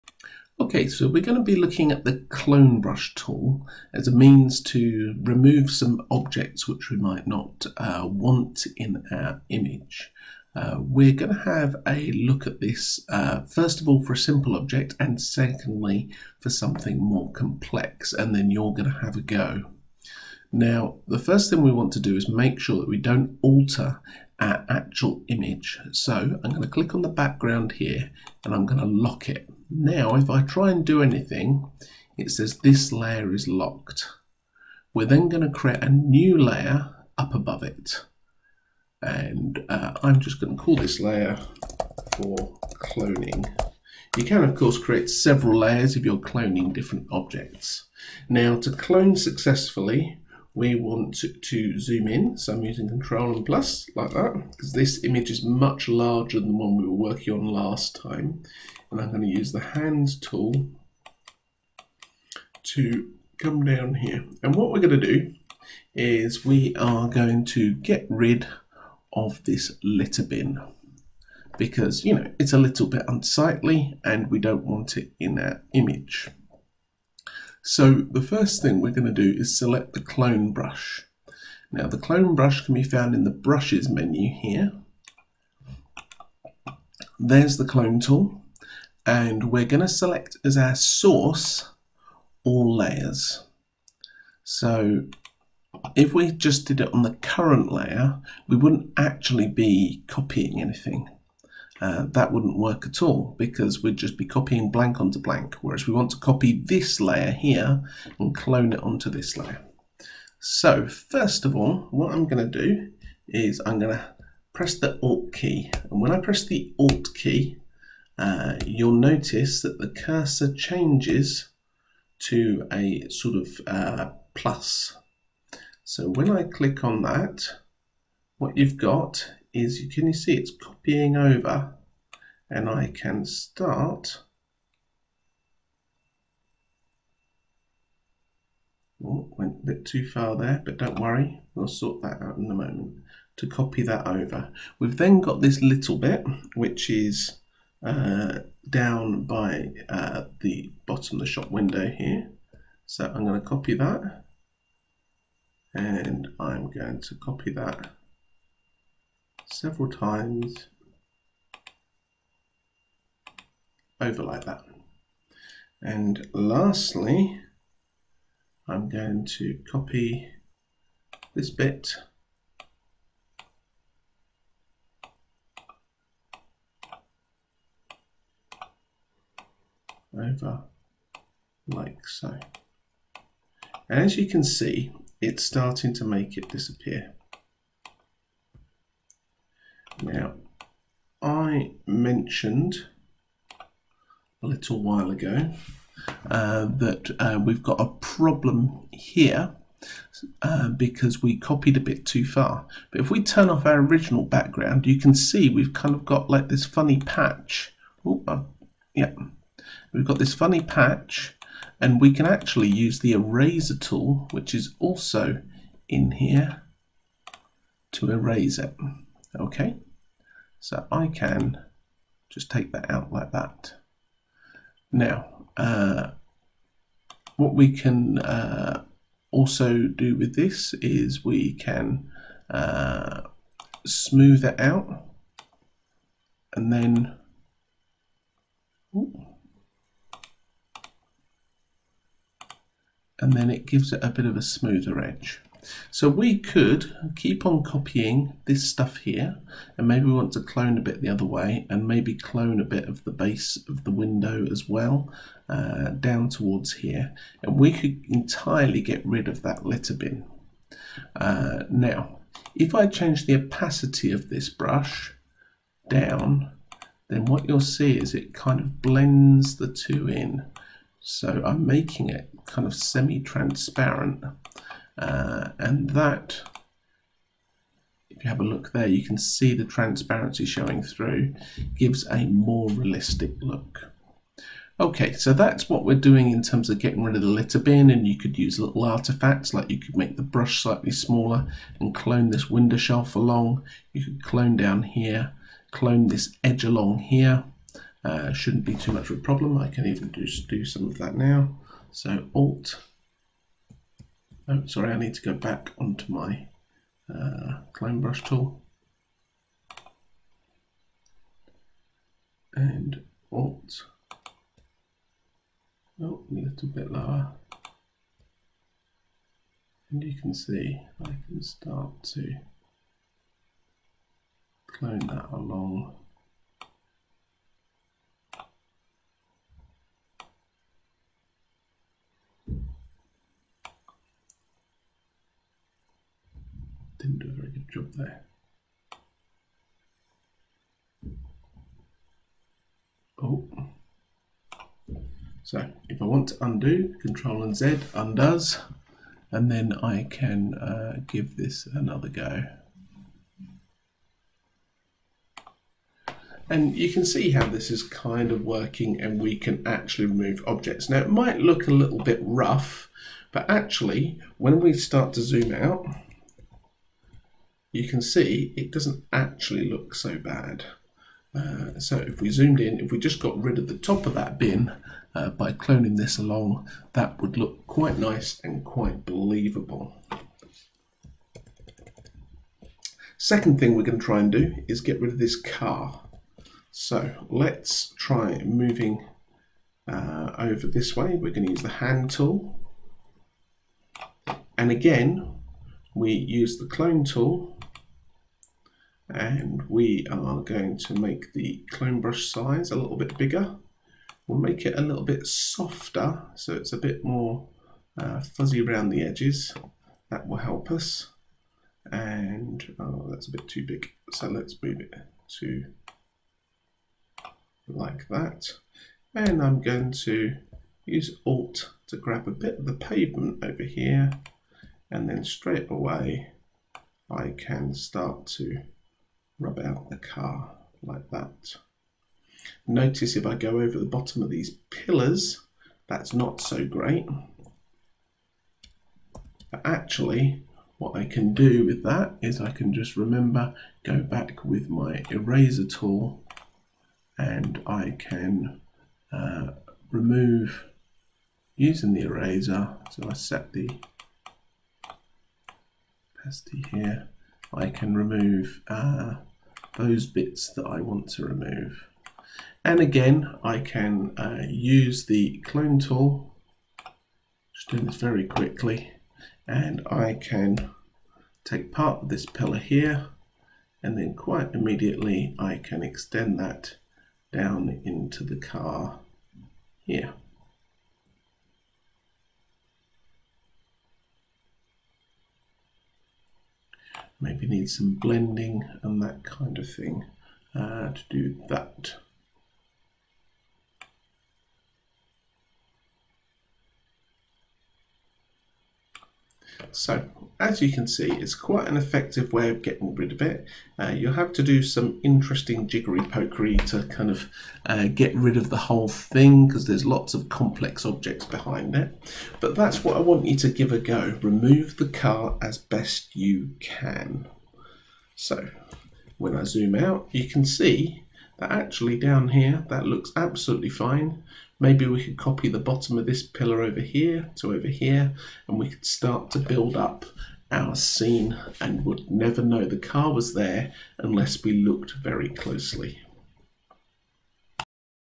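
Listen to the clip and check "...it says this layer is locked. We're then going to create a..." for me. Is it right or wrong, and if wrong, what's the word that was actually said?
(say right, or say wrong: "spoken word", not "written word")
right.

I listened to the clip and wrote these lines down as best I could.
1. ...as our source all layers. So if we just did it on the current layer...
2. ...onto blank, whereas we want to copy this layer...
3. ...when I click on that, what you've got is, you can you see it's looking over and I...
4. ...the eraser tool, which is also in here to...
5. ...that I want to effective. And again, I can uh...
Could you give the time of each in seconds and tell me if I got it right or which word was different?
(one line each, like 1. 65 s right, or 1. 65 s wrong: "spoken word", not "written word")
1. 90 s right
2. 105 s right
3. 126 s wrong: "copying", not "looking"
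4. 212 s right
5. 460 s wrong: "remove", not "effective".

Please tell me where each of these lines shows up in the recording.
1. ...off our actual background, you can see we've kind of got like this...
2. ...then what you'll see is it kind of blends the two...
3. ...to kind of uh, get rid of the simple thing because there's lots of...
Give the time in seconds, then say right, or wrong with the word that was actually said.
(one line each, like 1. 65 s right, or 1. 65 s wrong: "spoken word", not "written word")
1. 203 s wrong: "original", not "actual"
2. 267 s right
3. 506 s wrong: "whole", not "simple".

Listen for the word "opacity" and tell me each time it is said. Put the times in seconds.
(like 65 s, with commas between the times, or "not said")
263 s, 456 s.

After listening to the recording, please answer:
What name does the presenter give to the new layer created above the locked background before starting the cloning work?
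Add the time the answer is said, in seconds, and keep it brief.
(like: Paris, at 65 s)
for cloning, at 42 s.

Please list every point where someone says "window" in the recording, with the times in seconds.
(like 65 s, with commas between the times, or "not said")
151 s, 253 s, 292 s.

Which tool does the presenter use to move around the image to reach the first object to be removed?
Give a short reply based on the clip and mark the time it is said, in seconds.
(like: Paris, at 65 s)
Hands tool, at 59 s.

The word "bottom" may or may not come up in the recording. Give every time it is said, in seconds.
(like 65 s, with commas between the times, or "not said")
150 s, 433 s, 525 s.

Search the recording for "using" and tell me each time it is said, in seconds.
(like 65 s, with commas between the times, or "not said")
52 s, 451 s.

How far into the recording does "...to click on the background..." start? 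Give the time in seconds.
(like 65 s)
26 s.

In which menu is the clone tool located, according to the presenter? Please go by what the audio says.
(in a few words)
brushes menu.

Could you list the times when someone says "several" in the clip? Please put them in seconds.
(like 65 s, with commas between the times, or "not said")
45 s, 159 s.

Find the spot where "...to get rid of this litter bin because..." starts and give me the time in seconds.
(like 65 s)
67 s.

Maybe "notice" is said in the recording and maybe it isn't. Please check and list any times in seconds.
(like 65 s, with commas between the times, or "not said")
118 s, 432 s.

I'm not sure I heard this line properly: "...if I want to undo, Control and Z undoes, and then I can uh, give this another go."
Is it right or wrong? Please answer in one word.
right.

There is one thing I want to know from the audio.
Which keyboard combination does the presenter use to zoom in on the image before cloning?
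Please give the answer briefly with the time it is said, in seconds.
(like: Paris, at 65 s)
Control and Plus, at 52 s.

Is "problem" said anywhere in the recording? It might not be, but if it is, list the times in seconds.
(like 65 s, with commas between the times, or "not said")
197 s, 299 s.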